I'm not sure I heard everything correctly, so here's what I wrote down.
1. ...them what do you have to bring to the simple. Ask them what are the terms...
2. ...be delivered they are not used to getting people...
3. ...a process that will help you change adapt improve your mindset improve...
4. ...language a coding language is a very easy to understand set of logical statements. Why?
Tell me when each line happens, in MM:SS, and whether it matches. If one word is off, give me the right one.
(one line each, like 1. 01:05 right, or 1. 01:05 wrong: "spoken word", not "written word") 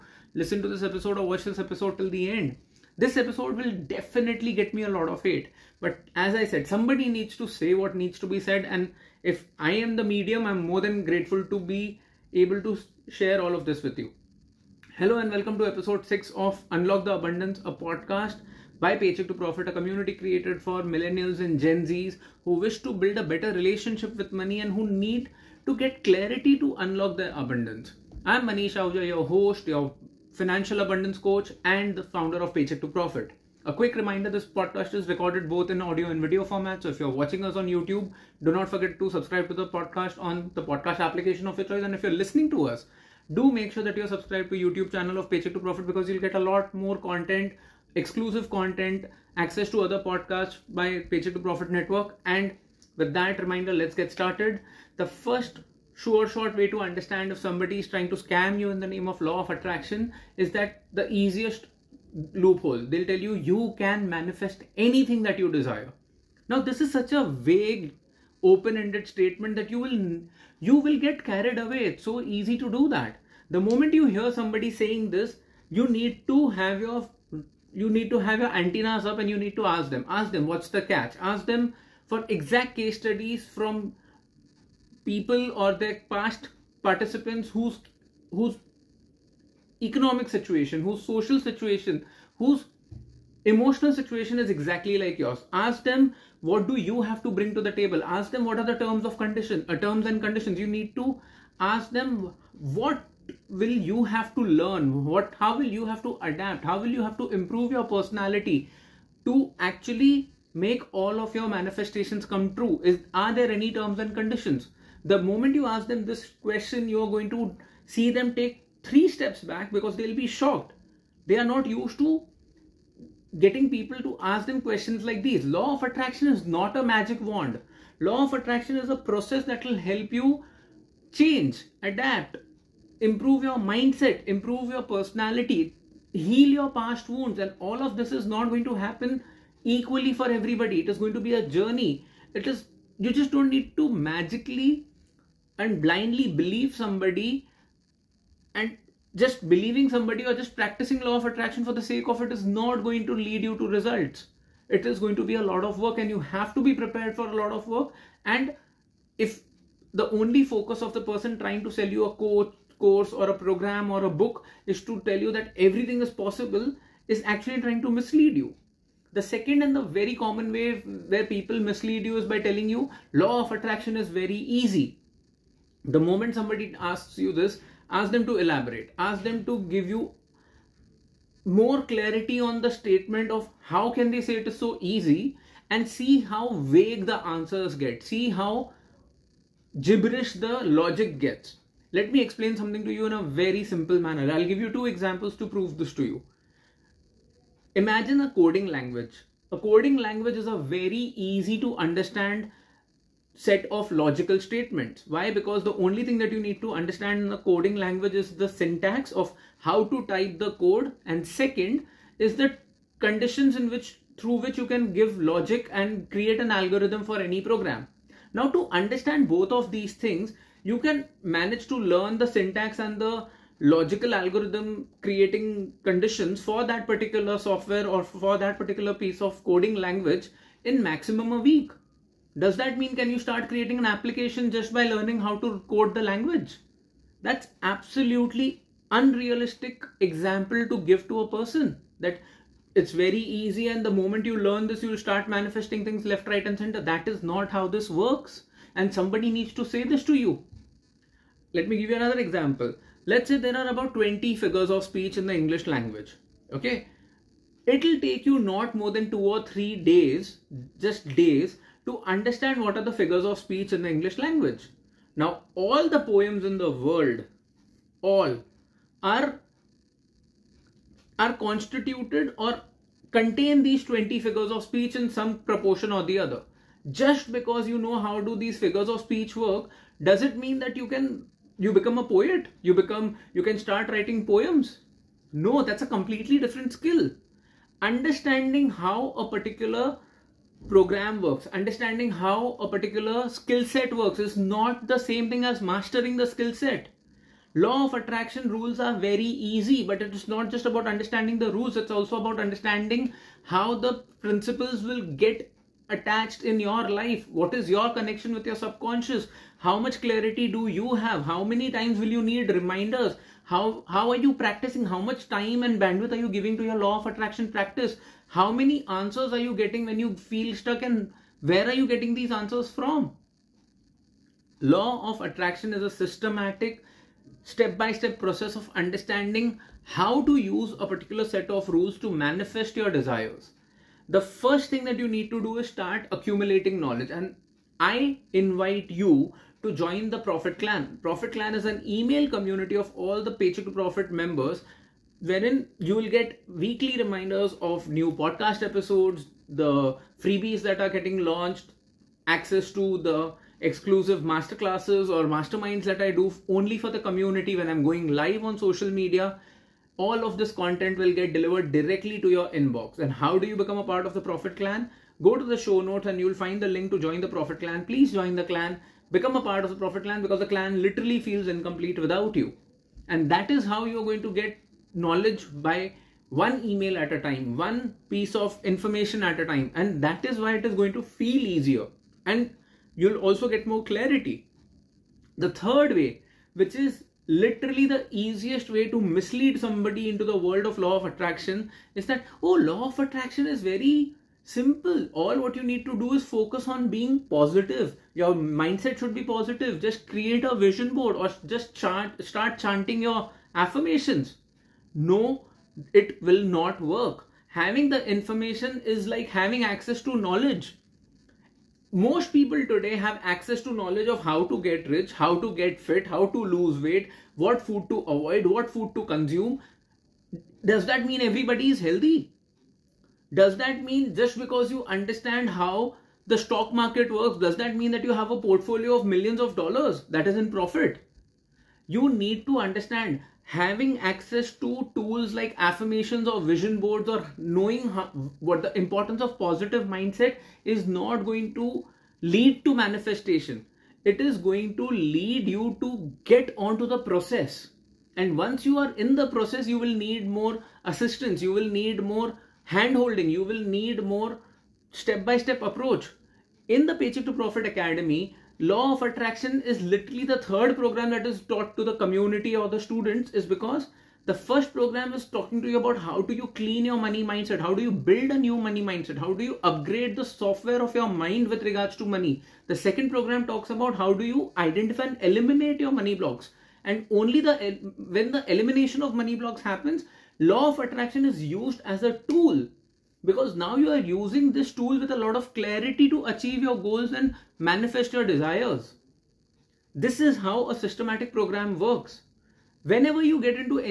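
1. 01:35 wrong: "table", not "simple"
2. 02:00 wrong: "shocked", not "delivered"
3. 02:08 right
4. 03:18 right.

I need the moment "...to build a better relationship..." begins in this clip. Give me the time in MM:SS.
00:22.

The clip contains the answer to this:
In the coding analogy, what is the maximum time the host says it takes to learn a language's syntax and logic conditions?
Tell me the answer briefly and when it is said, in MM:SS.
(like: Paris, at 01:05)
a week, at 03:51.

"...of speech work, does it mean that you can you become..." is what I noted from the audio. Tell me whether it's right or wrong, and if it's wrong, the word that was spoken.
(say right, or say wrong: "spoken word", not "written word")
right.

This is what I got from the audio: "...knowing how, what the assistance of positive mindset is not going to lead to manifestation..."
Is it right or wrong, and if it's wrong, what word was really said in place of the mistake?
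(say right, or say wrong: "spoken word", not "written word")
wrong: "importance", not "assistance".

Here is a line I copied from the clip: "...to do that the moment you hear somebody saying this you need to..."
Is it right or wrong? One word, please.
right.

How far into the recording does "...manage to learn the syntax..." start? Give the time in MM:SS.
03:41.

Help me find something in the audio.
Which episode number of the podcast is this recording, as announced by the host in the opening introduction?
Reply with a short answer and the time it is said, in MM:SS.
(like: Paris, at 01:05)
6, at 00:15.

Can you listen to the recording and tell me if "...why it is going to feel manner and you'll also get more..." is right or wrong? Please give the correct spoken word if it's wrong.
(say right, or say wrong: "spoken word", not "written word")
wrong: "easier", not "manner".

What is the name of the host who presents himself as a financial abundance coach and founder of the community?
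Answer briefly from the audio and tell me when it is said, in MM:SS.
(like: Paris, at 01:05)
Manish Ahuja, at 00:28.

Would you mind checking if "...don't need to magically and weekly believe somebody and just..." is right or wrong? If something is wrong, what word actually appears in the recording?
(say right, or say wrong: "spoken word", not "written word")
wrong: "blindly", not "weekly".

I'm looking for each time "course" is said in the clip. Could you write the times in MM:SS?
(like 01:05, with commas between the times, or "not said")
02:42.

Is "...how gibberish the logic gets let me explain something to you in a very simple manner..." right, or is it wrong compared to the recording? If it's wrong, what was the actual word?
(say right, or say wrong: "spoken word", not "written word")
right.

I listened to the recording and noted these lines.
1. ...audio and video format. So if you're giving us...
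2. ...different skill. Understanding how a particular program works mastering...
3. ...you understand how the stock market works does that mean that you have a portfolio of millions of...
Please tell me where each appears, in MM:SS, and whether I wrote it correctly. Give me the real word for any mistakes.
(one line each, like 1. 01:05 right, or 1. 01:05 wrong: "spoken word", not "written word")
1. 00:35 wrong: "watching", not "giving"
2. 04:46 wrong: "understanding", not "mastering"
3. 07:04 right.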